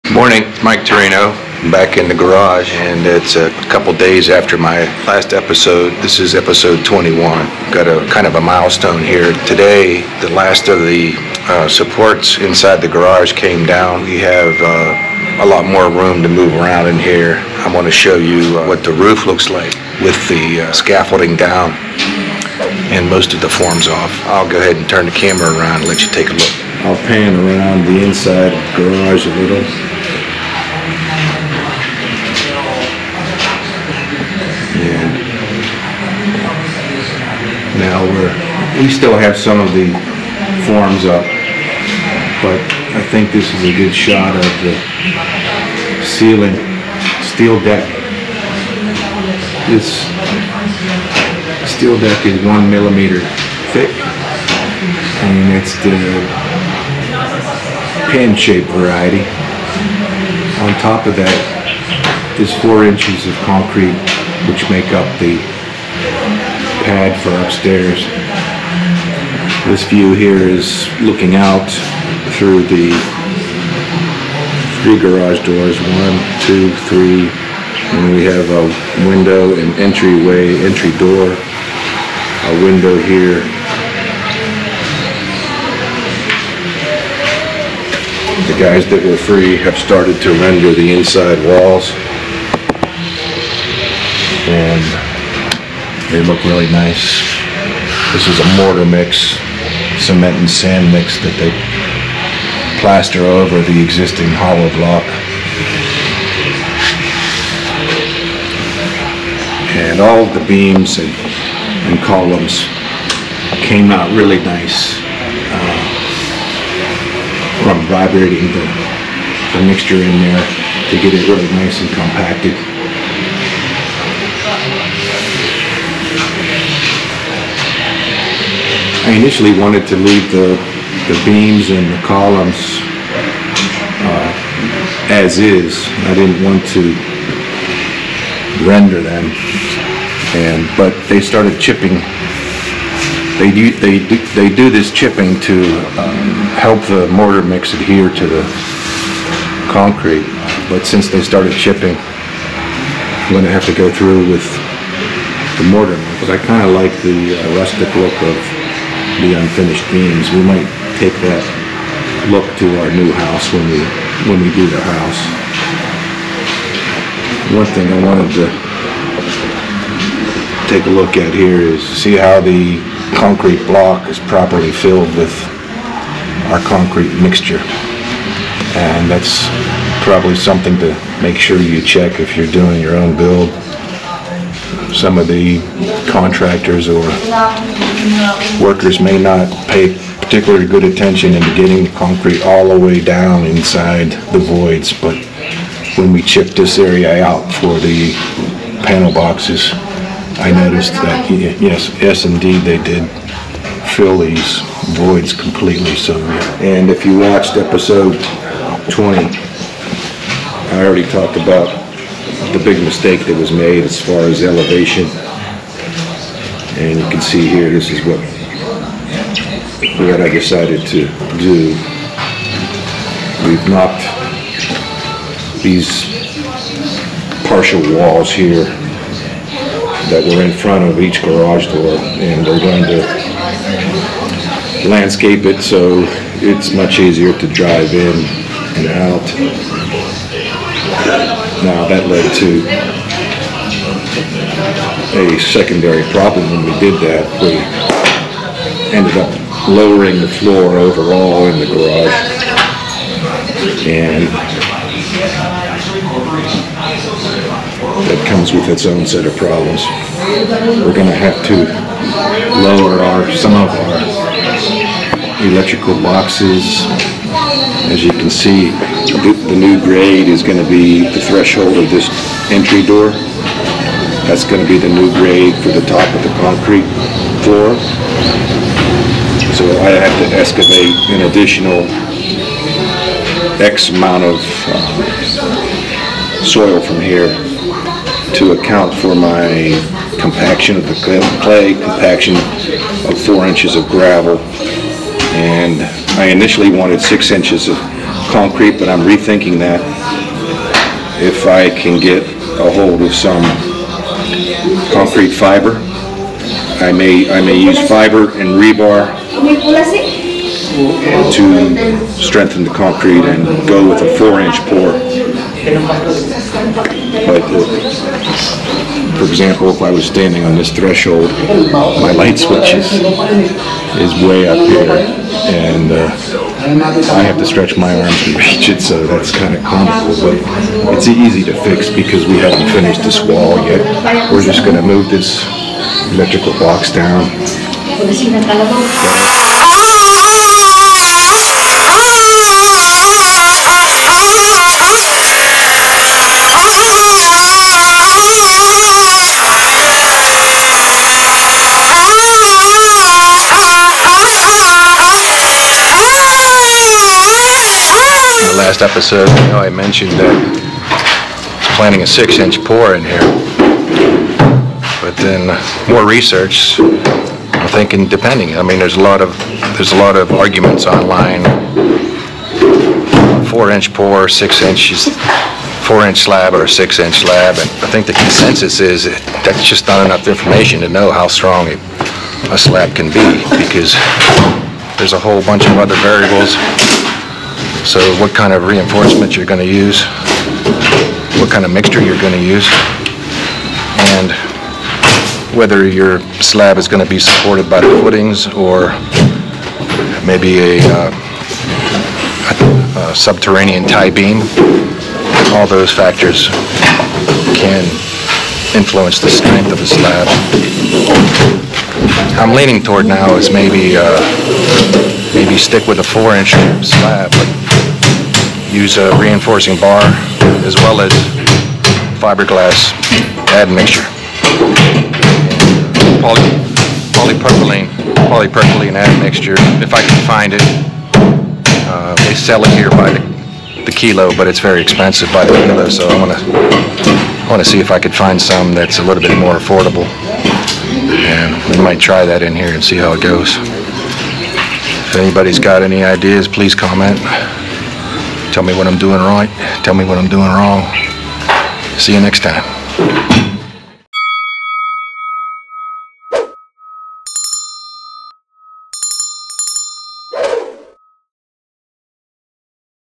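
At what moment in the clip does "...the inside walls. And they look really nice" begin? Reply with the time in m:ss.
1:30.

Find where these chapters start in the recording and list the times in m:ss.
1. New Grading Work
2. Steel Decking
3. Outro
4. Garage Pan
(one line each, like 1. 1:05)
1. 4:34
2. 0:47
3. 5:58
4. 0:32.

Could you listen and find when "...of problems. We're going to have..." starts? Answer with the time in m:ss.
4:19.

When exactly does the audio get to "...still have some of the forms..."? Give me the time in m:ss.
0:38.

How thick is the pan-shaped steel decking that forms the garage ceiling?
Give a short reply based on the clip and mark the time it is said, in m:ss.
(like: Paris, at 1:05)
1 millimeter, at 0:52.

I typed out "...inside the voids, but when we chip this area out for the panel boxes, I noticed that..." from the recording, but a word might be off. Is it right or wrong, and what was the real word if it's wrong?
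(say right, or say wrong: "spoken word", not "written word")
right.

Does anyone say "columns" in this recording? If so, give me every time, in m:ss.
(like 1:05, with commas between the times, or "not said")
1:52, 2:12.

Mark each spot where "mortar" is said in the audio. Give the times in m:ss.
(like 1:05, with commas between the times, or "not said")
1:38, 2:27, 2:35.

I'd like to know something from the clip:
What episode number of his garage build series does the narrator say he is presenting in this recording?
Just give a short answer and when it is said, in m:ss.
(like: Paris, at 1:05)
21, at 0:06.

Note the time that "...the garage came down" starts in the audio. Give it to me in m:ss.
0:12.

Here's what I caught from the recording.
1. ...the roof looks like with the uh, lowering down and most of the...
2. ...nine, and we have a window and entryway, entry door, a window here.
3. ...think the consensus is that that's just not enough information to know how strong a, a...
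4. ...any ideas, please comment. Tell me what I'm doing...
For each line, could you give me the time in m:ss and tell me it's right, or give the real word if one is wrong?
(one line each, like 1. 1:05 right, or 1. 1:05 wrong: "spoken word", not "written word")
1. 0:18 wrong: "scaffolding", not "lowering"
2. 1:16 wrong: "three", not "nine"
3. 6:17 right
4. 7:25 right.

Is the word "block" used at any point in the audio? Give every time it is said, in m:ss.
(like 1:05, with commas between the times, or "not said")
1:44, 2:53.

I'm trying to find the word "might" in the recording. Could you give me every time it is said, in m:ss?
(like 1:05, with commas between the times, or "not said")
2:40, 7:21.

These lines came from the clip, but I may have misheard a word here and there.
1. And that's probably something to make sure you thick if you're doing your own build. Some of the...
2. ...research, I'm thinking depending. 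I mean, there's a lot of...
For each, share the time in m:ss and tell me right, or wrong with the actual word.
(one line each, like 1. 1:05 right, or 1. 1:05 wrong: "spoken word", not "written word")
1. 2:58 wrong: "check", not "thick"
2. 6:06 right.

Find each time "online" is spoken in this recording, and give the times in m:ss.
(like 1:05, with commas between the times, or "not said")
6:10.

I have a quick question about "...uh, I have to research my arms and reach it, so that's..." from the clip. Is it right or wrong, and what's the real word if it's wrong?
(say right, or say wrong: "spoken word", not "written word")
wrong: "stretch", not "research".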